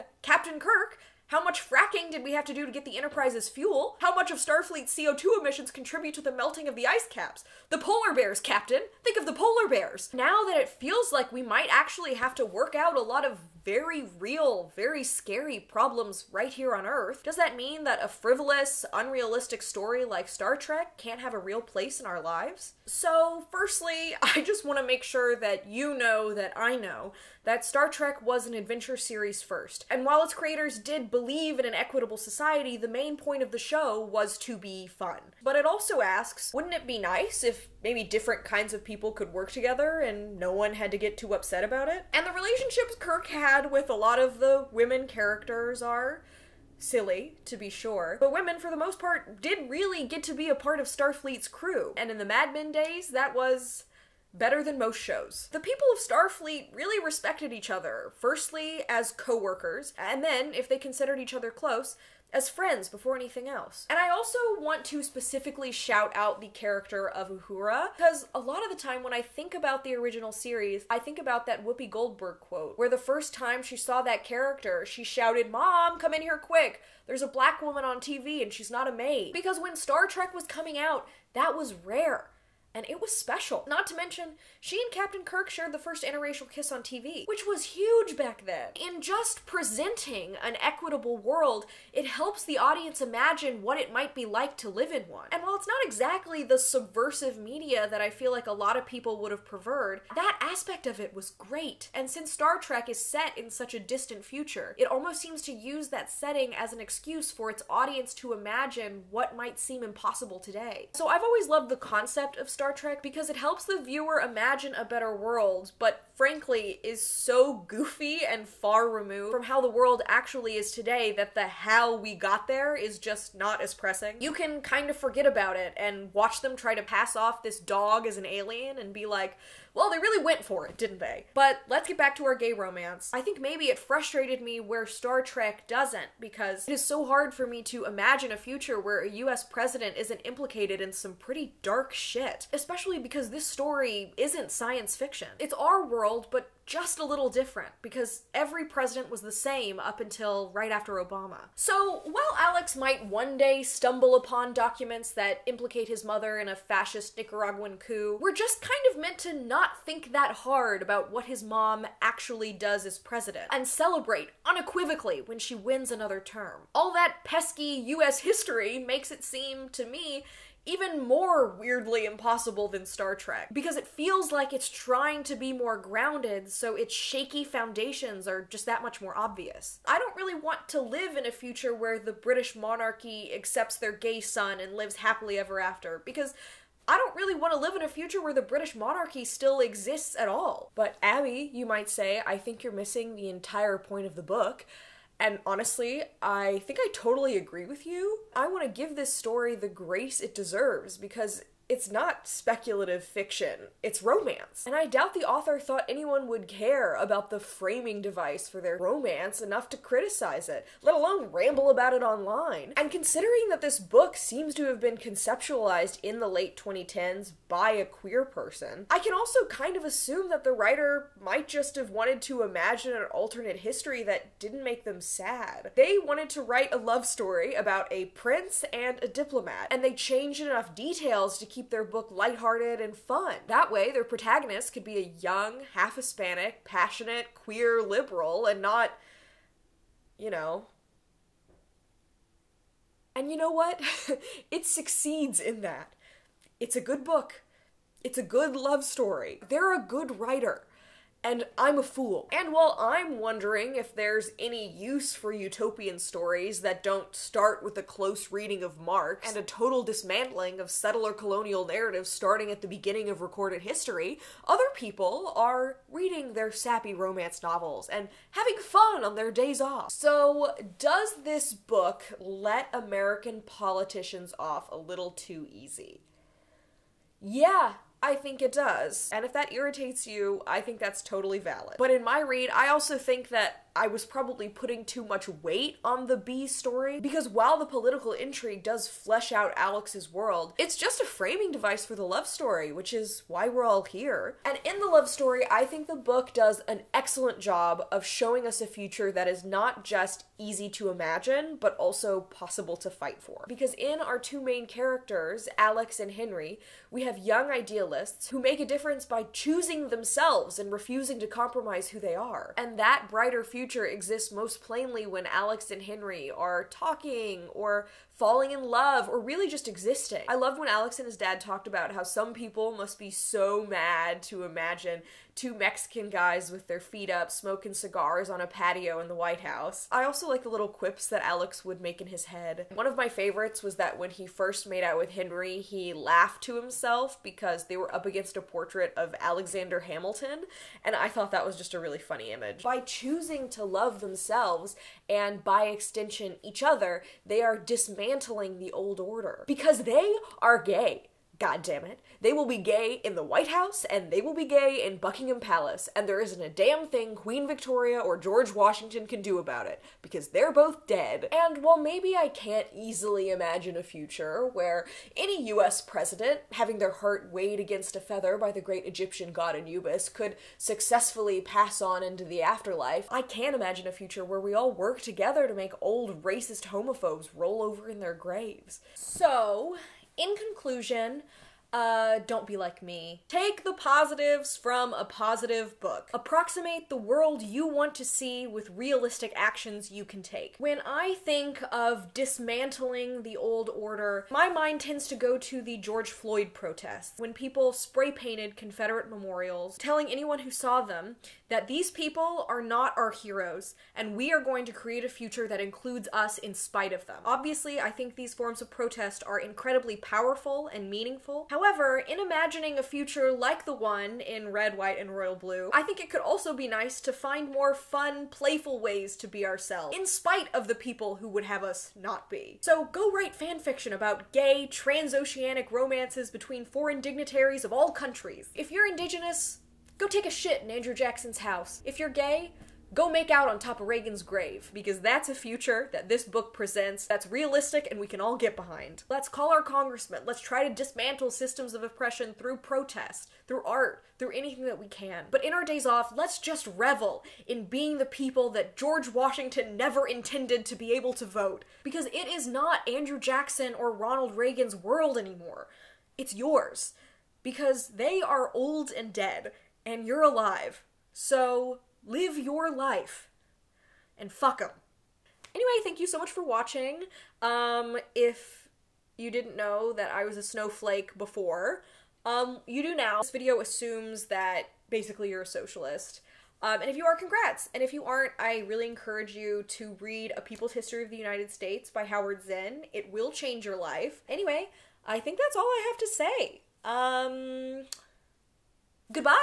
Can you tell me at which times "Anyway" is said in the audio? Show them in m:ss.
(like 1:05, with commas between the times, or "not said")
7:45, 8:04.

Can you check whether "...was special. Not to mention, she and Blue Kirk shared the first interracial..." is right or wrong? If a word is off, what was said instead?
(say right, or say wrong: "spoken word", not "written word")
wrong: "Captain", not "Blue".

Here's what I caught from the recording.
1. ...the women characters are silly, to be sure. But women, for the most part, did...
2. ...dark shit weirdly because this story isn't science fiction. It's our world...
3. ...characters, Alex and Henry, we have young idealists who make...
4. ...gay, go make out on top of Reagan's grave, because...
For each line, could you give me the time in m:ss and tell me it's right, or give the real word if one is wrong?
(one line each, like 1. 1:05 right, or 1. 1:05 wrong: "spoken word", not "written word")
1. 0:44 right
2. 2:21 wrong: "especially", not "weirdly"
3. 5:04 right
4. 7:12 right.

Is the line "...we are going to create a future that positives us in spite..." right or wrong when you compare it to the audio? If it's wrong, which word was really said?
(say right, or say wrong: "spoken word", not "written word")
wrong: "includes", not "positives".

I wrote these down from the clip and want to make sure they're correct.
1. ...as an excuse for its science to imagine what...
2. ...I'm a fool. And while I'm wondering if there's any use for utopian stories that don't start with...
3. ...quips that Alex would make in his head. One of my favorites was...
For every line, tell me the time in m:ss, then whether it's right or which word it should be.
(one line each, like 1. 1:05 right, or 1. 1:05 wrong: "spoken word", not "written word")
1. 1:46 wrong: "audience", not "science"
2. 4:11 right
3. 5:30 right.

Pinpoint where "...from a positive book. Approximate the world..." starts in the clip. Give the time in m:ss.
6:24.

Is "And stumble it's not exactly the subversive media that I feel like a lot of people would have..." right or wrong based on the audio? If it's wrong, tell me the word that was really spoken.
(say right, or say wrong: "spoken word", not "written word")
wrong: "while", not "stumble".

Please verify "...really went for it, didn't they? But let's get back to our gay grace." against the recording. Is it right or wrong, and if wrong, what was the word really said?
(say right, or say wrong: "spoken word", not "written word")
wrong: "romance", not "grace".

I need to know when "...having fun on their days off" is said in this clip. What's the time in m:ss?
4:28.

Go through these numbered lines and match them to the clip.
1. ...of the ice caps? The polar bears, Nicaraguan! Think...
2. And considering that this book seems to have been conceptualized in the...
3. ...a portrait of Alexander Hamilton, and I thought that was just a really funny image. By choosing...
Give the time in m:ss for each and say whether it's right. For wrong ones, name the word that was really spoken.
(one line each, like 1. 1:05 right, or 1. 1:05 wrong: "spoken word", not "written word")
1. 0:06 wrong: "Captain", not "Nicaraguan"
2. 3:32 right
3. 5:38 right.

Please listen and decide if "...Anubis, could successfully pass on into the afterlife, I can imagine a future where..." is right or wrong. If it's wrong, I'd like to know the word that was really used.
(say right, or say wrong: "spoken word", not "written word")
right.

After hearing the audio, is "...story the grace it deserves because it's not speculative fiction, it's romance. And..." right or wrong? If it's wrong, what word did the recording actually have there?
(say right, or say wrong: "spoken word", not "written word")
right.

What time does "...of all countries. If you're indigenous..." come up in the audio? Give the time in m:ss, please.
7:07.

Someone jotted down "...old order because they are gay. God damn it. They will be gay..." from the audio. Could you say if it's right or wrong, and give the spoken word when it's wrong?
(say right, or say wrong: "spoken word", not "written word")
right.